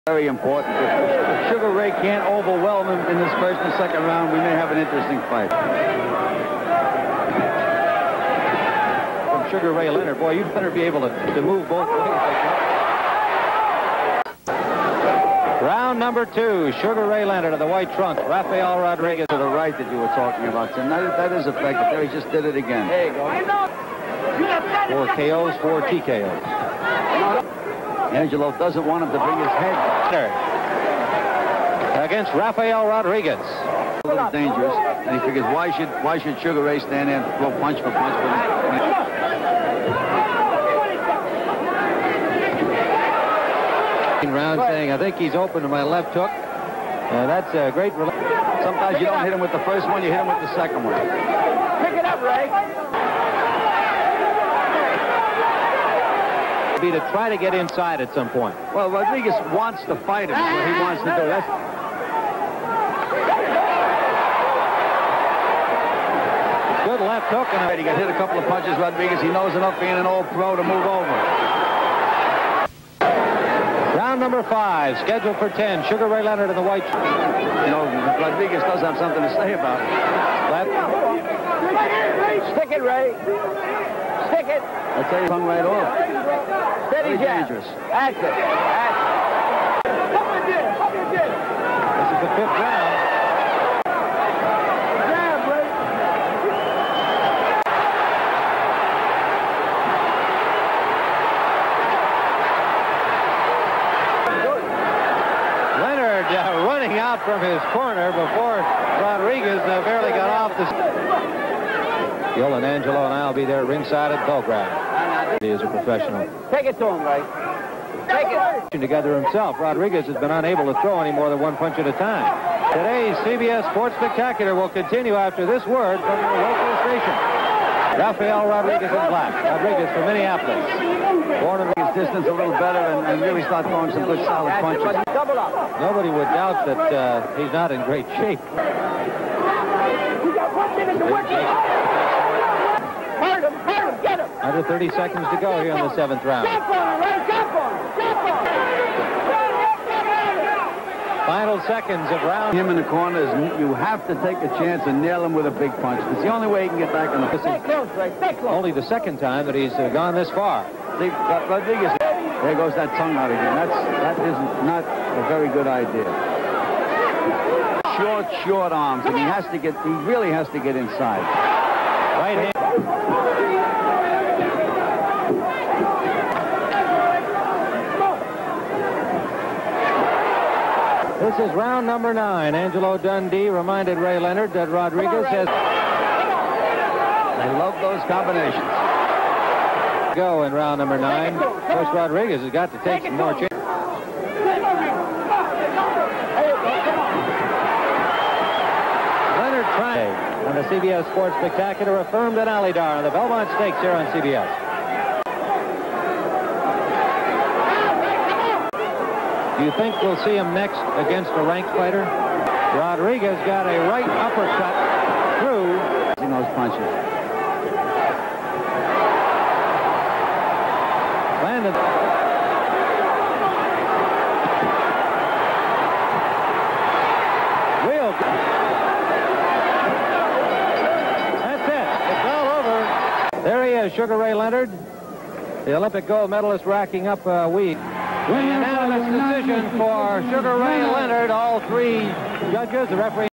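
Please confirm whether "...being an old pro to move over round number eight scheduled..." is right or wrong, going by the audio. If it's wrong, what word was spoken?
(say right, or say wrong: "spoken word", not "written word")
wrong: "five", not "eight".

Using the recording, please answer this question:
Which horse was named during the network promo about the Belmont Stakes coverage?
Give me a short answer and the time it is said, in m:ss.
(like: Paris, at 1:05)
Alydar, at 3:22.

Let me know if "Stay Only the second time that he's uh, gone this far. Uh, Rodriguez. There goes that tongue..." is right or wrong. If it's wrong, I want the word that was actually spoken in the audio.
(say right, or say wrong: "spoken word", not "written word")
right.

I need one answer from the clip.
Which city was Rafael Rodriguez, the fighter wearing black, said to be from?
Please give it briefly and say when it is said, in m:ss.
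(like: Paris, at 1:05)
Minneapolis, at 2:10.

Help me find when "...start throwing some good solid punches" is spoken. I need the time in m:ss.
2:13.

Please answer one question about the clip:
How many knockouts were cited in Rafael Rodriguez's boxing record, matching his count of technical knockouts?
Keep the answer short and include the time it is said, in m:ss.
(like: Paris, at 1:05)
4, at 0:24.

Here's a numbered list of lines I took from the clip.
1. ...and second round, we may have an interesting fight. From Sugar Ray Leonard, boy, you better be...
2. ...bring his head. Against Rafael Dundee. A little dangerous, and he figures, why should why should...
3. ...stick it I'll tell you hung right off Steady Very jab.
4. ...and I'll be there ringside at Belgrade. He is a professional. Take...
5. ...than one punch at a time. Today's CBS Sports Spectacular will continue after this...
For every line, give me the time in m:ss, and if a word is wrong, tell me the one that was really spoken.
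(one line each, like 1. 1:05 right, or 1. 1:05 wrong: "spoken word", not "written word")
1. 0:03 right
2. 0:29 wrong: "Rodriguez", not "Dundee"
3. 1:24 right
4. 1:53 right
5. 2:01 right.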